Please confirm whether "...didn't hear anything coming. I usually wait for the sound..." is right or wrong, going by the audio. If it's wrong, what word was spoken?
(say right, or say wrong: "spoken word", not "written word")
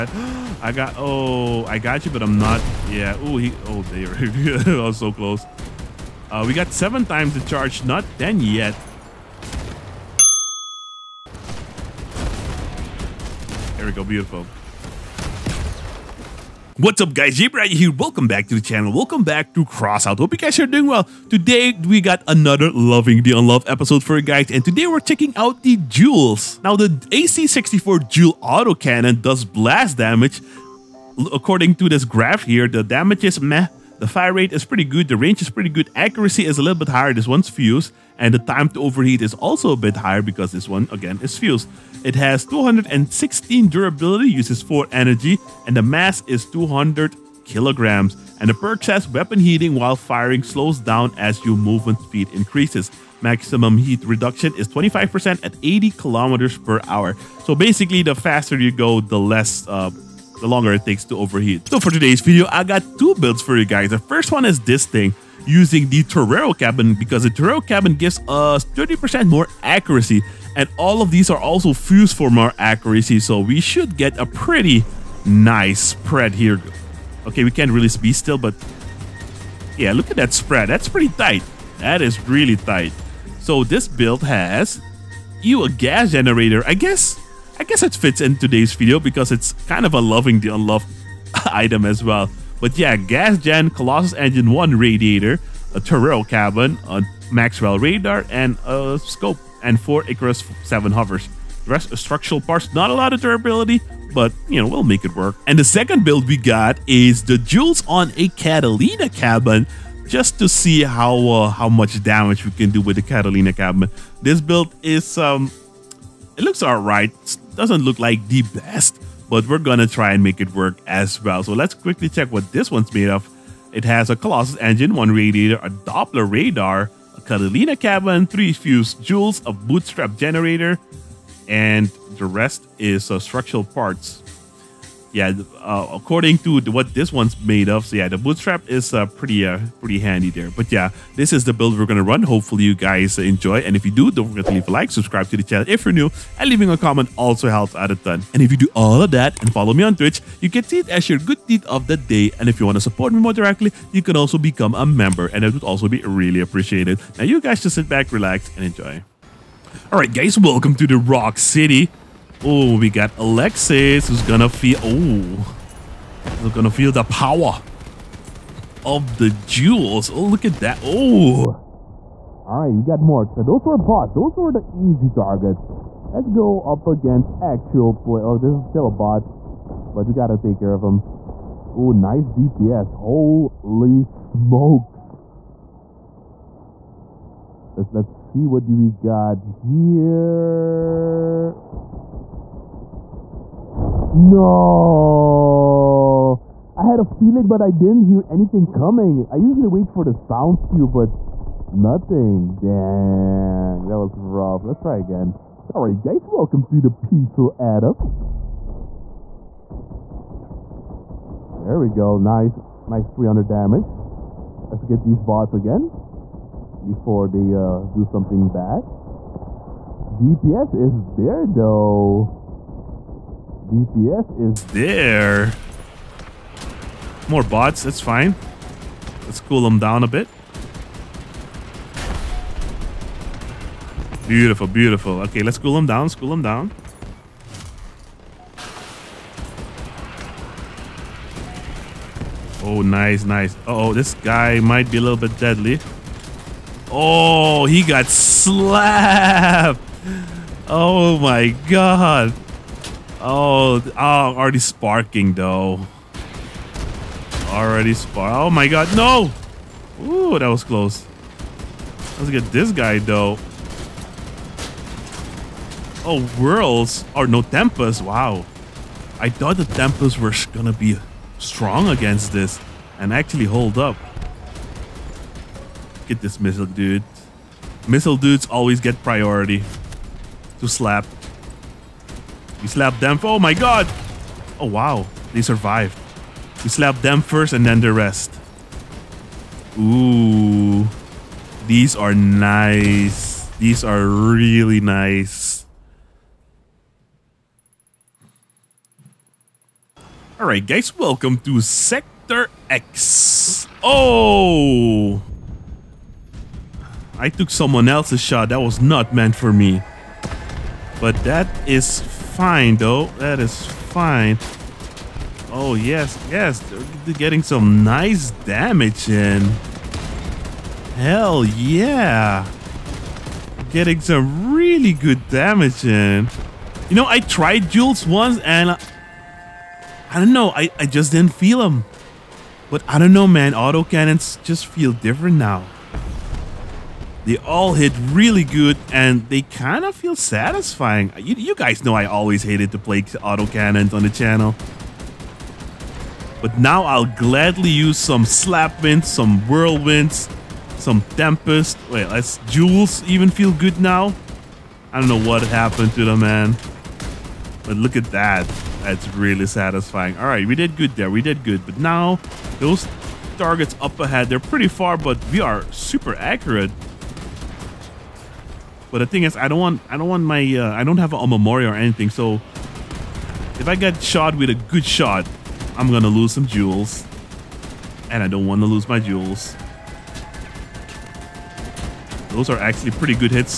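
right.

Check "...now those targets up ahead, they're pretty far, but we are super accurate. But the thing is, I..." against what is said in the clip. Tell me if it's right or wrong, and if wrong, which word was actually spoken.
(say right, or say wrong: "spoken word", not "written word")
right.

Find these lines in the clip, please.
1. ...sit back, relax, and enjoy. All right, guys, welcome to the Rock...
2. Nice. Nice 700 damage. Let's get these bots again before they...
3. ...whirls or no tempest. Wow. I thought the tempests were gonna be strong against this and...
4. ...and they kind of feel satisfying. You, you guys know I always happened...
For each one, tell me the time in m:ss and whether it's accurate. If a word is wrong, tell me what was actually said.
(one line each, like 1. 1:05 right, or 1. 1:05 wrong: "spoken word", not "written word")
1. 2:37 right
2. 3:32 wrong: "300", not "700"
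3. 4:26 right
4. 5:38 wrong: "hated", not "happened".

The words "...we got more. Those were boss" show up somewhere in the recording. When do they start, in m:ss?
2:52.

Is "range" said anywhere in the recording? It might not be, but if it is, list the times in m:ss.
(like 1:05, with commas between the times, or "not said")
0:35.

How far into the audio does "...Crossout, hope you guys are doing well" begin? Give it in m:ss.
0:19.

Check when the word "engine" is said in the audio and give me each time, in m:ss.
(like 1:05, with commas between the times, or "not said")
1:34, 2:04.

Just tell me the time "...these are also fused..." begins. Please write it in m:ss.
1:11.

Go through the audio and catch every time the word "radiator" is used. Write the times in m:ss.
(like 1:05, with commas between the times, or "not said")
1:34, 2:05.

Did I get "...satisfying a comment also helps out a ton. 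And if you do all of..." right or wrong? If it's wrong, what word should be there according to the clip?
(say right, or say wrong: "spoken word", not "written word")
wrong: "leaving", not "satisfying".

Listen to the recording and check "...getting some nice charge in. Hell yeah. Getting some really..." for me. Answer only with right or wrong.
wrong.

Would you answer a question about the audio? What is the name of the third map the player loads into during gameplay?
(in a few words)
Sector EX.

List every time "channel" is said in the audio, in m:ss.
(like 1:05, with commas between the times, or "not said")
0:18, 2:25, 5:44.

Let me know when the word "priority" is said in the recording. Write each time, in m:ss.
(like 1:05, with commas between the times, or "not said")
4:39.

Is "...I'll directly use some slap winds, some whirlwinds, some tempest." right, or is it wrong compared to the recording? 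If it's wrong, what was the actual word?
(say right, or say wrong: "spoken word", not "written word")
wrong: "gladly", not "directly".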